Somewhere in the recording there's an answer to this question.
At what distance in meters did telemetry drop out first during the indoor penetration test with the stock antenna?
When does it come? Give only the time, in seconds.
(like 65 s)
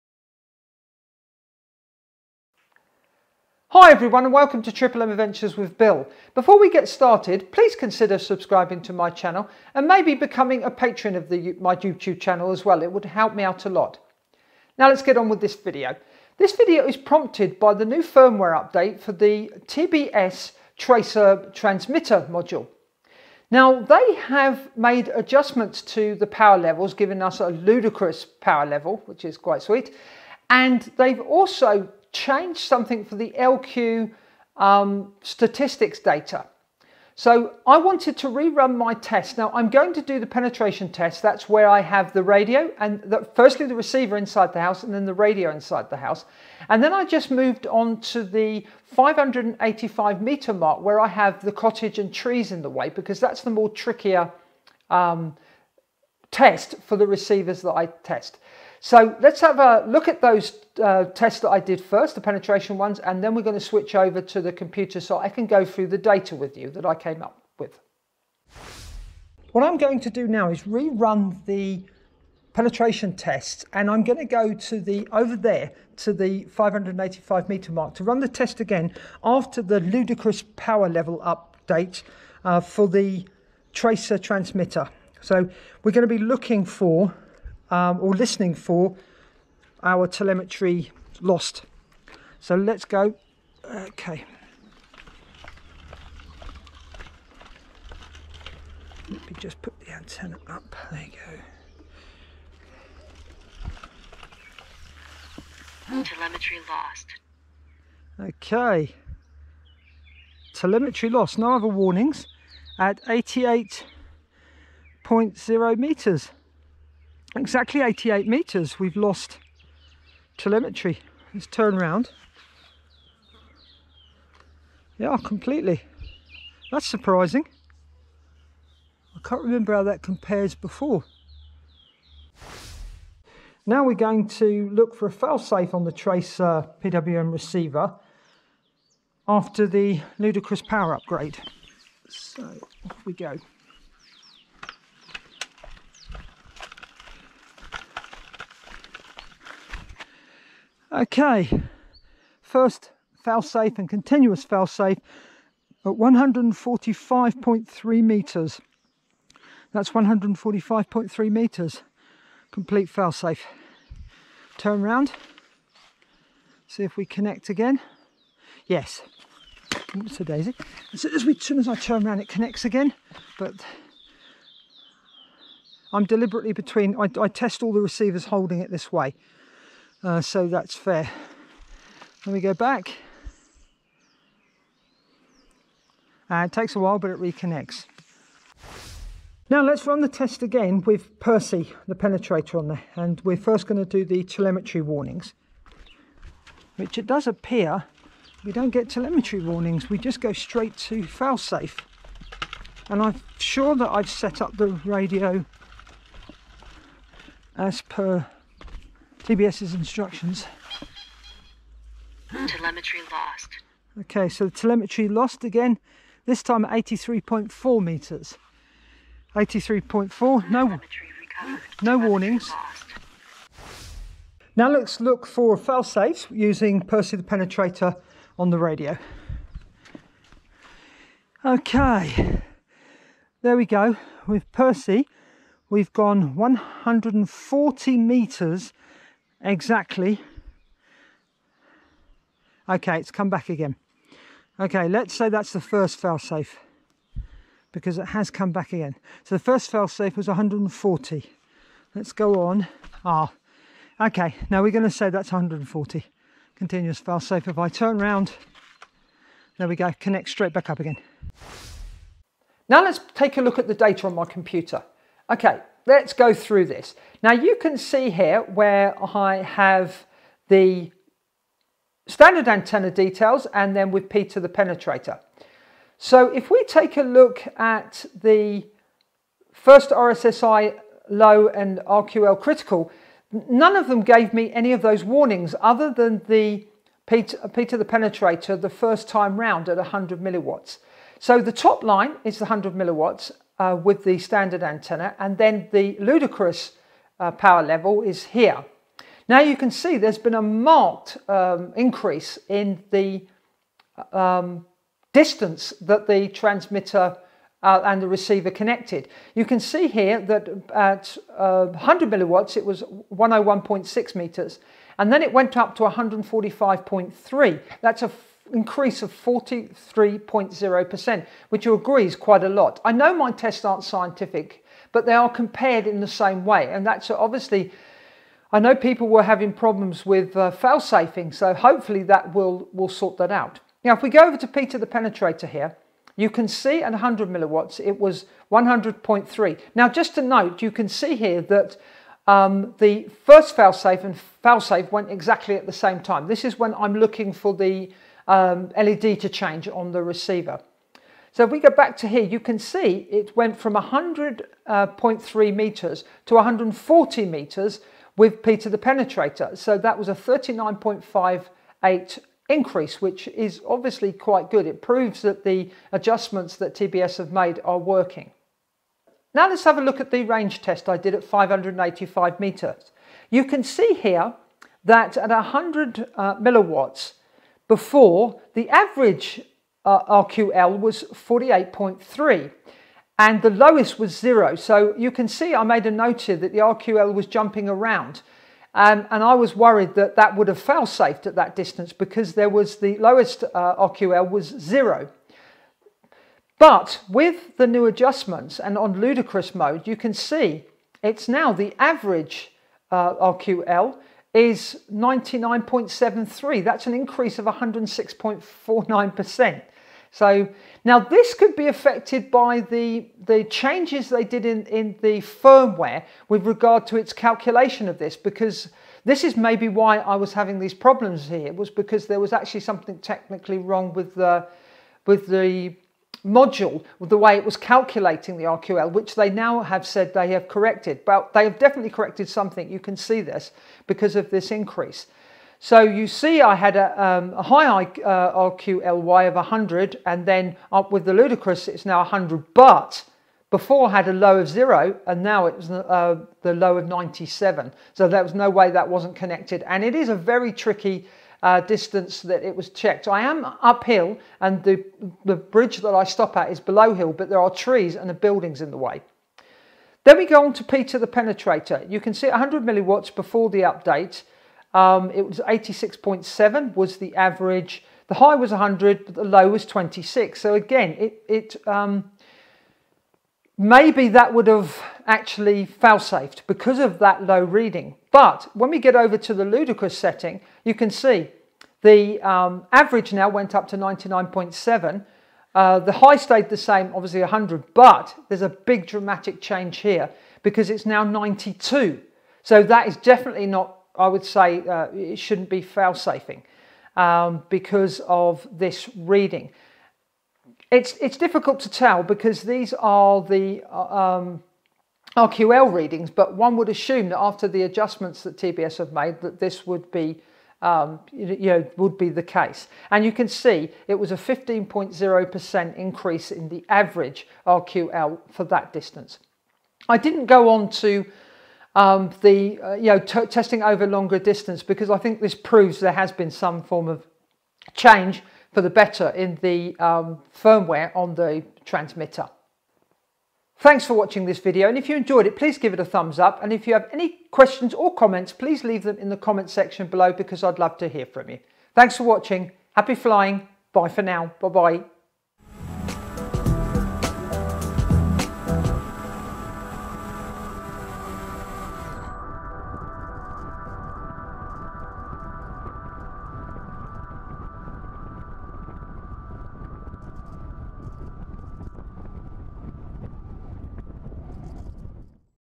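117 s.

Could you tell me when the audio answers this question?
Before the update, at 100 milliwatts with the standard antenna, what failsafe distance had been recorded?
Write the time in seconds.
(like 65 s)
313 s.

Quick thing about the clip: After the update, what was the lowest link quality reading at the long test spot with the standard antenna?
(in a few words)
97.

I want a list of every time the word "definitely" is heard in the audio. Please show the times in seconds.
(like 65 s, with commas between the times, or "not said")
431 s, 492 s.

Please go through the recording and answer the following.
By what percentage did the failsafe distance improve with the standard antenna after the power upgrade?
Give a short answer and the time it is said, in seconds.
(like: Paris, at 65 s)
43.0%, at 319 s.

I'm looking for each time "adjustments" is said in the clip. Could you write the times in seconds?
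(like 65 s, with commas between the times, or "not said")
25 s, 365 s, 397 s, 507 s.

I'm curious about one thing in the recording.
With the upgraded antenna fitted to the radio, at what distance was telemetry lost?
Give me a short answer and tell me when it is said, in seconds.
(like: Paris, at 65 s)
83.4 meters, at 216 s.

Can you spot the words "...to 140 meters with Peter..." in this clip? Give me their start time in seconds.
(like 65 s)
356 s.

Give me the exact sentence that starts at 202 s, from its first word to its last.
And I'm sure that I've set up the radio as per TBS's instructions.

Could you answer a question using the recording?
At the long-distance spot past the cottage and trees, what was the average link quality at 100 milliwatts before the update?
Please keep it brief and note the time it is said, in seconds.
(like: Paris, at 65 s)
48.3, at 381 s.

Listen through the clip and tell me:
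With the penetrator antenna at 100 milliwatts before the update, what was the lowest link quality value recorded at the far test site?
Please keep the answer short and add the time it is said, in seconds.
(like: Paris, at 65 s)
26, at 469 s.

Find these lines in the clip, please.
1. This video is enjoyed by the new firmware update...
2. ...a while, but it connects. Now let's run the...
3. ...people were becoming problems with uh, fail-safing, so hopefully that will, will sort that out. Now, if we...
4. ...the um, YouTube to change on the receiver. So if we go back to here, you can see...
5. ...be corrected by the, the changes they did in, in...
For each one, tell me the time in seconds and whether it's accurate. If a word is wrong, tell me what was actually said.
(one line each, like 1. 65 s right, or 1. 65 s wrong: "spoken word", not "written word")
1. 16 s wrong: "prompted", not "enjoyed"
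2. 186 s wrong: "reconnects", not "connects"
3. 328 s wrong: "having", not "becoming"
4. 347 s wrong: "LED", not "YouTube"
5. 411 s wrong: "affected", not "corrected".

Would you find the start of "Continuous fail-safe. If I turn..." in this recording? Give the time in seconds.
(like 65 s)
256 s.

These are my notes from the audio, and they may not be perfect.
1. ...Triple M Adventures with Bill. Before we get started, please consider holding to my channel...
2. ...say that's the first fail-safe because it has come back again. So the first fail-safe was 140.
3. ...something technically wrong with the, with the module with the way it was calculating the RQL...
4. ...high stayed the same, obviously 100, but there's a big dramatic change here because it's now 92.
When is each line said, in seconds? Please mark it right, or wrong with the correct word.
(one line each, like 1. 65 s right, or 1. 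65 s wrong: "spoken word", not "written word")
1. 4 s wrong: "subscribing", not "holding"
2. 245 s right
3. 422 s right
4. 485 s right.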